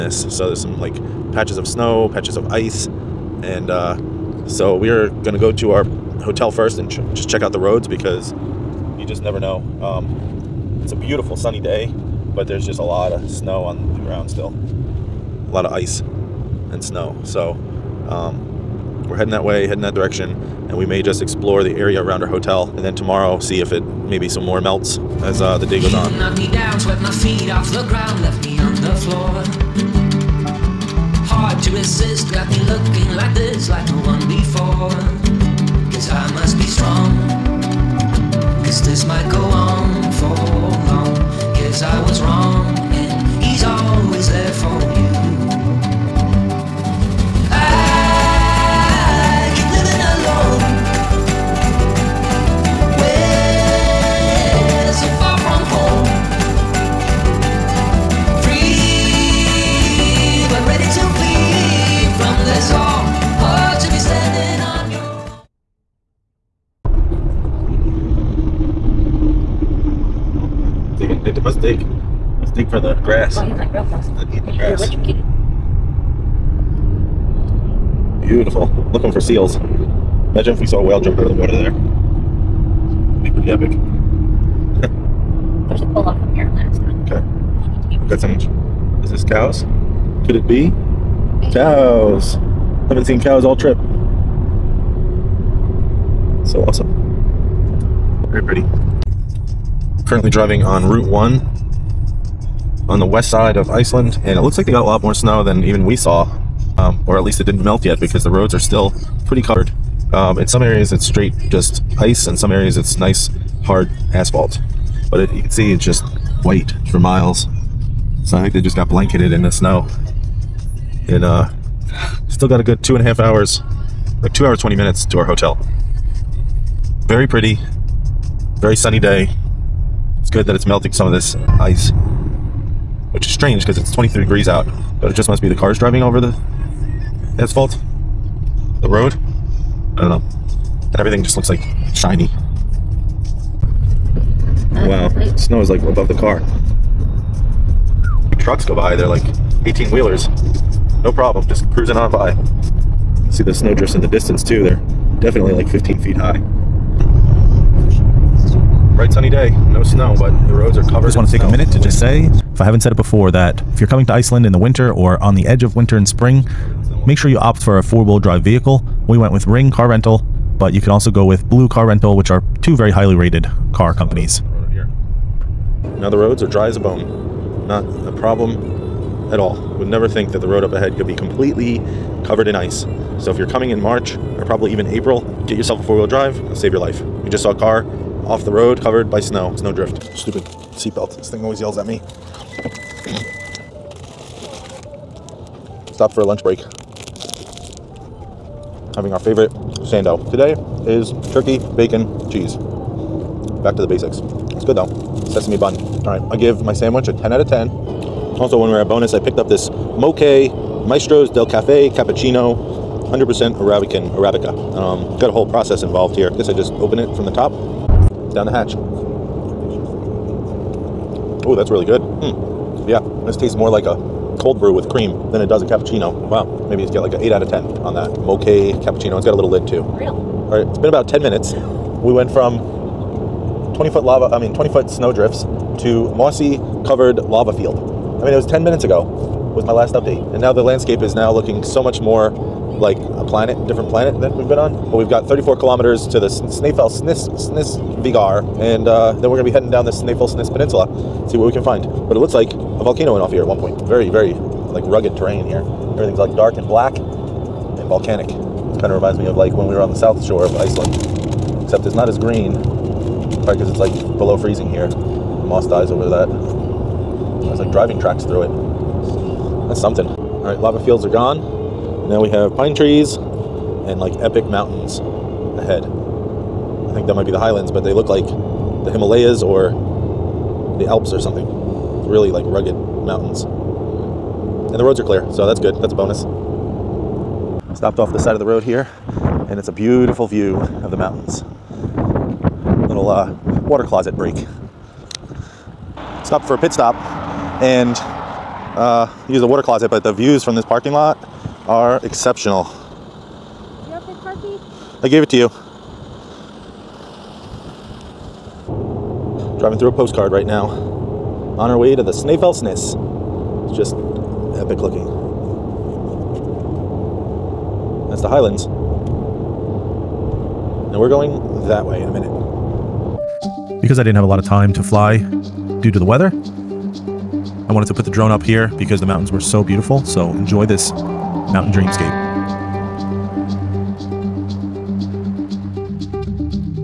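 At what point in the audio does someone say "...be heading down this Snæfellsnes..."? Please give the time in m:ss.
4:09.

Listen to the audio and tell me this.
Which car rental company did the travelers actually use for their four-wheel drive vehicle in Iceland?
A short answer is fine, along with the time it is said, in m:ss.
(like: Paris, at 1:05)
Ring Car Rental, at 2:49.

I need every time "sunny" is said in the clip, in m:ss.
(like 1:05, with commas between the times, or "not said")
0:11, 2:08, 2:39.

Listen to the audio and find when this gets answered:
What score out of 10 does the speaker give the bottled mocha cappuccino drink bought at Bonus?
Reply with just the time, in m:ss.
3:47.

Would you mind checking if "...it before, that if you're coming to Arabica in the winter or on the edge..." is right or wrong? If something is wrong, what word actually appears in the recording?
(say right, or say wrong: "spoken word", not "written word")
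wrong: "Iceland", not "Arabica".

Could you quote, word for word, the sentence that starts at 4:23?
Probably because it's like below freezing here.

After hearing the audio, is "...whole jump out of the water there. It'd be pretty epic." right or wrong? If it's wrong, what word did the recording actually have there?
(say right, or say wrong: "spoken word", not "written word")
wrong: "whale", not "whole".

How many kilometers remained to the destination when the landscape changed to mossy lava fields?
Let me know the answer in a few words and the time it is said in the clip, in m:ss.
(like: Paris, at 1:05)
34, at 4:05.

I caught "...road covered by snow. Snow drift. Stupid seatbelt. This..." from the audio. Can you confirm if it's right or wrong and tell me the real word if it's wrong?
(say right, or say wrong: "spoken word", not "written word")
right.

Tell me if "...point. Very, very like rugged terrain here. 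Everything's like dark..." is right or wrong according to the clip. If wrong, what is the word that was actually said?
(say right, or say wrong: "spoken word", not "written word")
right.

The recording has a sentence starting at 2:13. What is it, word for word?
Which is strange because it's 23 degrees out.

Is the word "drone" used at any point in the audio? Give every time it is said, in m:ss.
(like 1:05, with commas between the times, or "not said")
5:28.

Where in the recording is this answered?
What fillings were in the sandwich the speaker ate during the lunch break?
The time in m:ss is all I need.
3:21.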